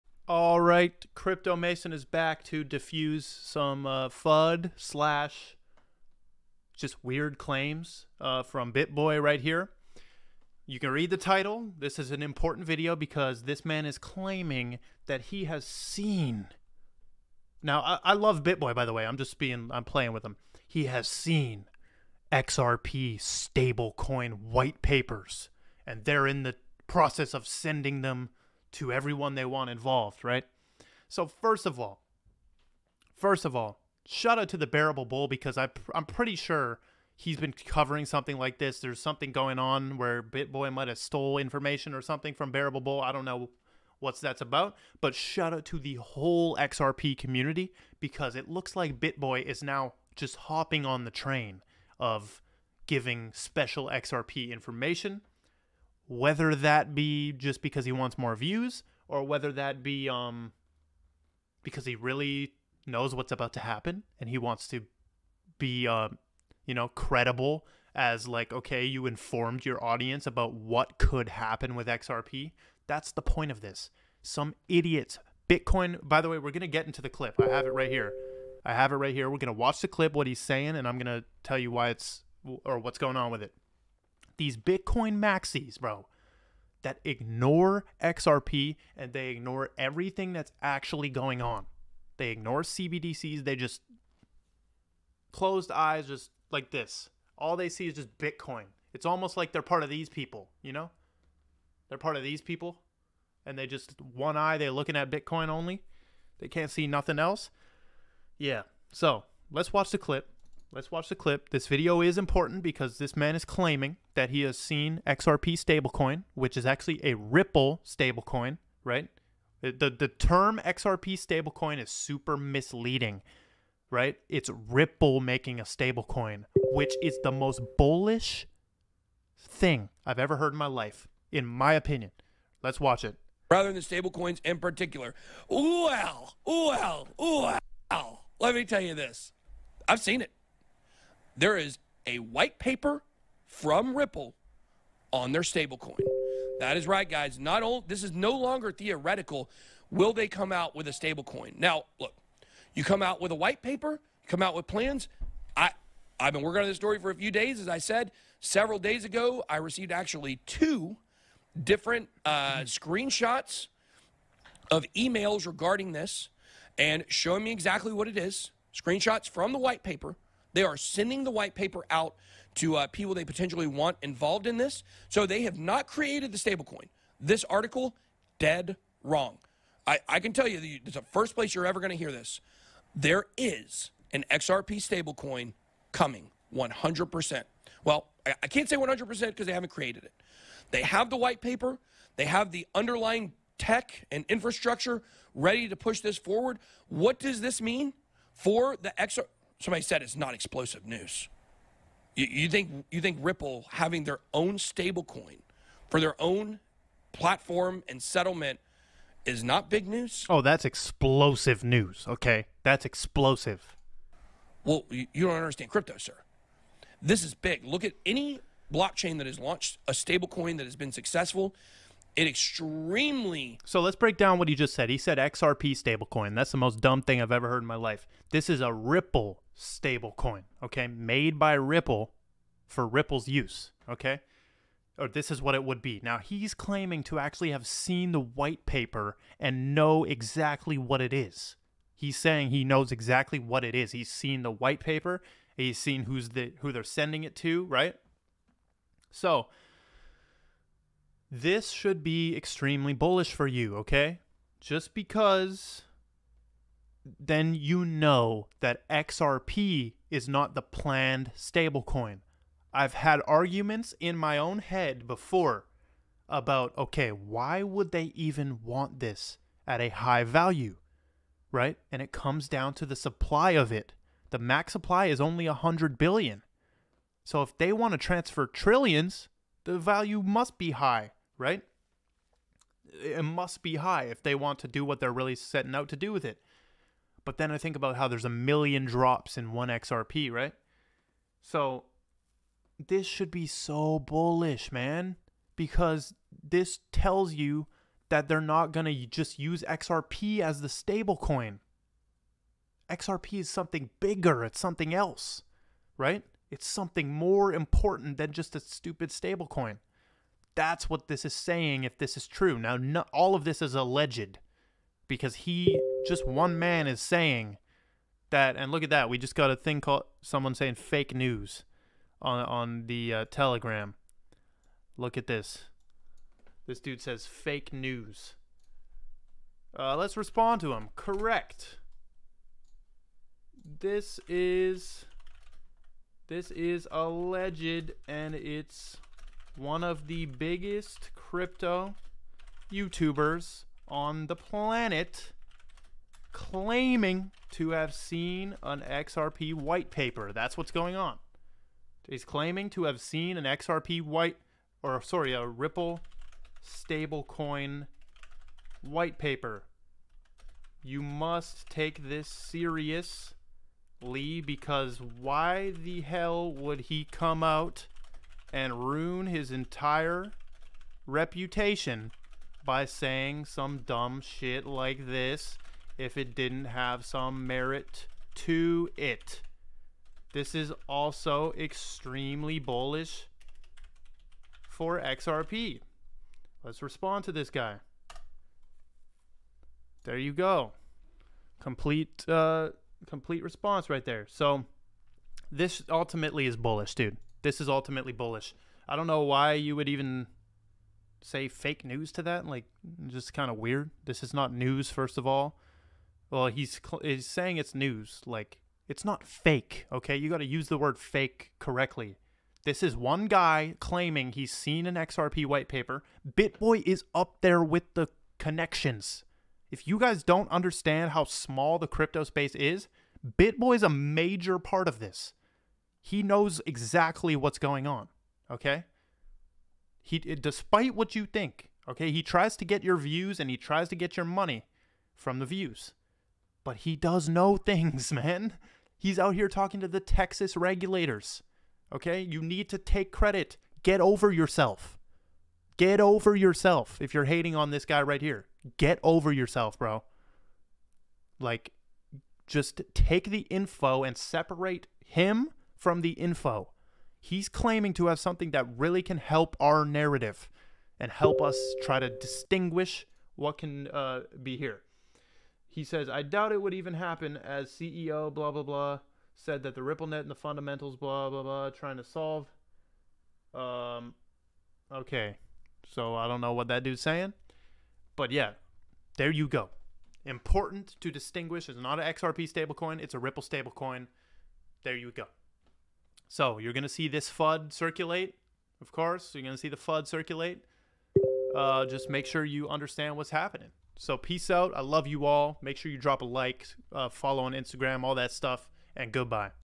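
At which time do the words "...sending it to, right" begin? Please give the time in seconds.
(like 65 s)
246 s.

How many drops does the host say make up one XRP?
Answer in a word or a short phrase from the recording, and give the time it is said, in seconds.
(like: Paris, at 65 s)
1 million, at 288 s.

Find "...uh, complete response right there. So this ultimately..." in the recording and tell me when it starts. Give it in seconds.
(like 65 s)
392 s.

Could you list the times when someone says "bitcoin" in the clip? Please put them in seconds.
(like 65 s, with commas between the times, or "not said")
75 s, 84 s, 98 s, 105 s.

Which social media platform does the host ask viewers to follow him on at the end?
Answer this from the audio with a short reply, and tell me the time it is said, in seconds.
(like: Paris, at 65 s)
Instagram, at 497 s.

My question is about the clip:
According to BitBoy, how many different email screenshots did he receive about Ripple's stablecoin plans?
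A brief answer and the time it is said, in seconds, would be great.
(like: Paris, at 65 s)
2, at 160 s.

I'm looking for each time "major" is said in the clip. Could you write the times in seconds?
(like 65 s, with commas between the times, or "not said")
423 s.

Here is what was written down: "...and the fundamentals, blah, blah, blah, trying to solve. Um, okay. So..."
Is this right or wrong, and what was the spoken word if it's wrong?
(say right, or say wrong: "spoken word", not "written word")
right.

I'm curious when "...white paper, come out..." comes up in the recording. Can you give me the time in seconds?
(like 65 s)
153 s.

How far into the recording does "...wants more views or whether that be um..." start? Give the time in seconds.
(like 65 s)
57 s.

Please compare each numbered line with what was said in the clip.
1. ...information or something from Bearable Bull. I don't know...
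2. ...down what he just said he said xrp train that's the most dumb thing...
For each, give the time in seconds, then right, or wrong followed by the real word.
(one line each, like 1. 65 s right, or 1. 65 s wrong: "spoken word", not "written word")
1. 41 s right
2. 224 s wrong: "stablecoin", not "train".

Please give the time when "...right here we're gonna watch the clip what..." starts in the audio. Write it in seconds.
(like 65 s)
78 s.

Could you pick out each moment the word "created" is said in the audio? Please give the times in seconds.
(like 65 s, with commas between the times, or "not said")
175 s, 189 s.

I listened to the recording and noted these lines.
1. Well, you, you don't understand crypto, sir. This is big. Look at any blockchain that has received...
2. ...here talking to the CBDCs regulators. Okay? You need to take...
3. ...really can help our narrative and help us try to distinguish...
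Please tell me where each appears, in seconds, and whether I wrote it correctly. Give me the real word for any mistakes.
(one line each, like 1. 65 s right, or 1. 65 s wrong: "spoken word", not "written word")
1. 214 s wrong: "launched", not "received"
2. 439 s wrong: "Texas", not "CBDCs"
3. 458 s right.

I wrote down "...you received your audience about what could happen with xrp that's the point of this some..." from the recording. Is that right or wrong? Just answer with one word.
wrong.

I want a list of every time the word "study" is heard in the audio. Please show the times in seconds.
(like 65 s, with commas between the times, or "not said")
not said.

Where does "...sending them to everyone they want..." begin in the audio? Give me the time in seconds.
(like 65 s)
27 s.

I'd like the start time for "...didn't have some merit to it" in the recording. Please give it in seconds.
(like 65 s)
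376 s.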